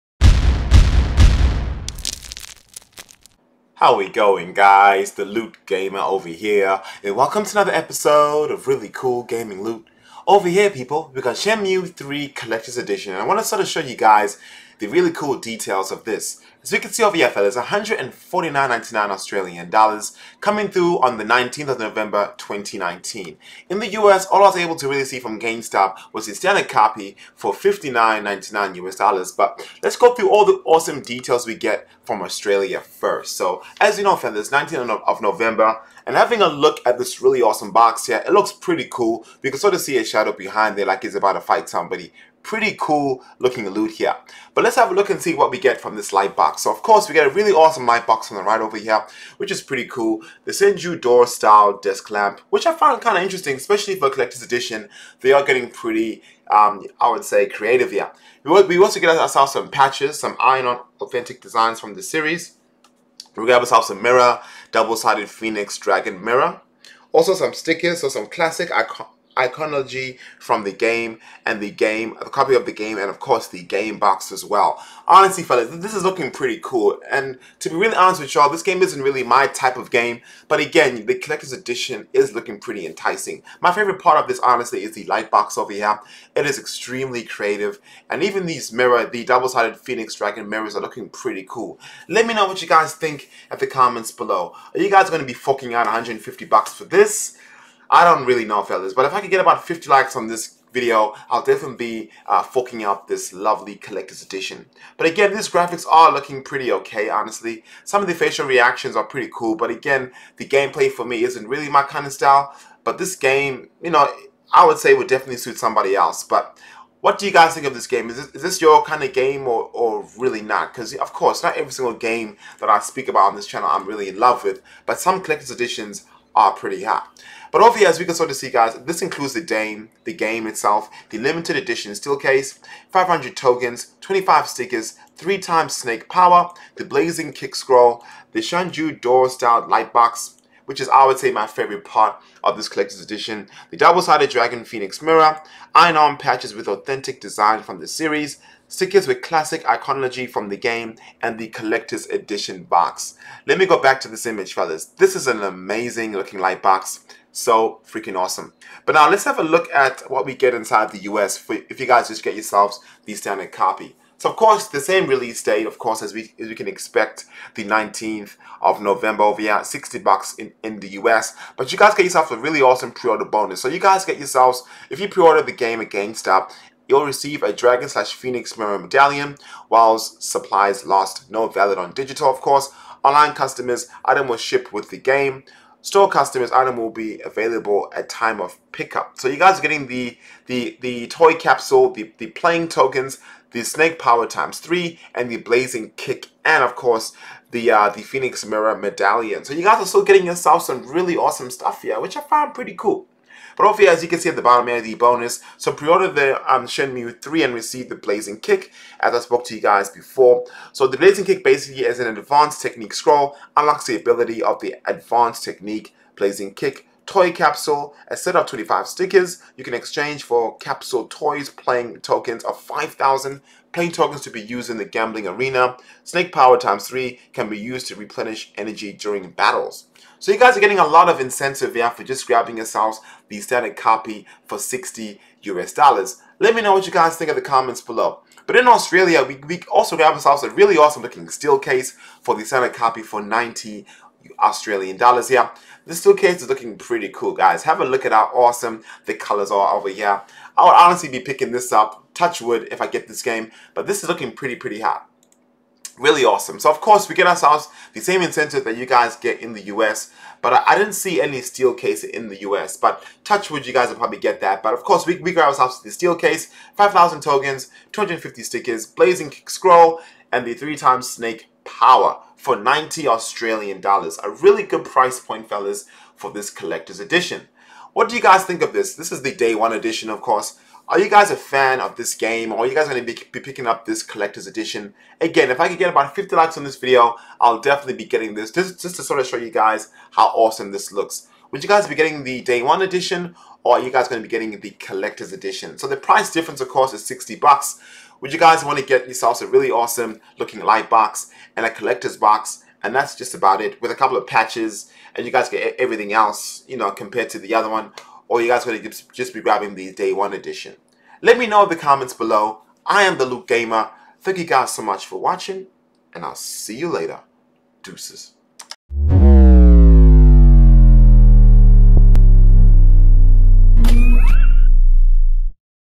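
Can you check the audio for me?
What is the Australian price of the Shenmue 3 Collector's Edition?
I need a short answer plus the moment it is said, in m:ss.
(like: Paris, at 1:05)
149.99 Australian dollars, at 0:17.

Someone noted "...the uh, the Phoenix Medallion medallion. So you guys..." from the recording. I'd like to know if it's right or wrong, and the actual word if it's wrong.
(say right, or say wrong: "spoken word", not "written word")
wrong: "Mirror", not "Medallion".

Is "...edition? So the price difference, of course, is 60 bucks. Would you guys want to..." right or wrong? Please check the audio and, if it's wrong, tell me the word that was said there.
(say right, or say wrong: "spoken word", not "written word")
right.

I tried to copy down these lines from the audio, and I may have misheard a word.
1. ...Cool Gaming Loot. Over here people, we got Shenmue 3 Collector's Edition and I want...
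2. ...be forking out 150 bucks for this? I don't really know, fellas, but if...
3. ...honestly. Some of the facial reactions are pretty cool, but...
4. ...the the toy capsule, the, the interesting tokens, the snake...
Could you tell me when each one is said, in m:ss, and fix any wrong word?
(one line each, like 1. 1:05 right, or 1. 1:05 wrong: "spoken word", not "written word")
1. 0:08 right
2. 1:35 right
3. 1:47 right
4. 3:10 wrong: "playing", not "interesting".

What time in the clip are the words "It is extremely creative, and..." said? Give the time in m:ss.
1:26.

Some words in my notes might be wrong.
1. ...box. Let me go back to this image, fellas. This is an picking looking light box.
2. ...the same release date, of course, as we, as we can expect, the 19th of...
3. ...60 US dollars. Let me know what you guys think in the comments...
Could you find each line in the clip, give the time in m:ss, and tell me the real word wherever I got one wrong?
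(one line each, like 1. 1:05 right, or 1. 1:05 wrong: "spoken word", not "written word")
1. 2:32 wrong: "amazing", not "picking"
2. 2:44 right
3. 3:54 right.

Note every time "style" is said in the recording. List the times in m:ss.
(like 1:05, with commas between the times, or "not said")
0:51, 1:52, 2:19.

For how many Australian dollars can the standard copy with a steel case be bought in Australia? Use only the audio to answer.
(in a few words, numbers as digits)
90.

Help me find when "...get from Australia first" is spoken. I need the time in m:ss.
0:31.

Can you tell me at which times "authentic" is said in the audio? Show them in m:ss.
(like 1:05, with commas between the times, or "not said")
1:00, 2:26.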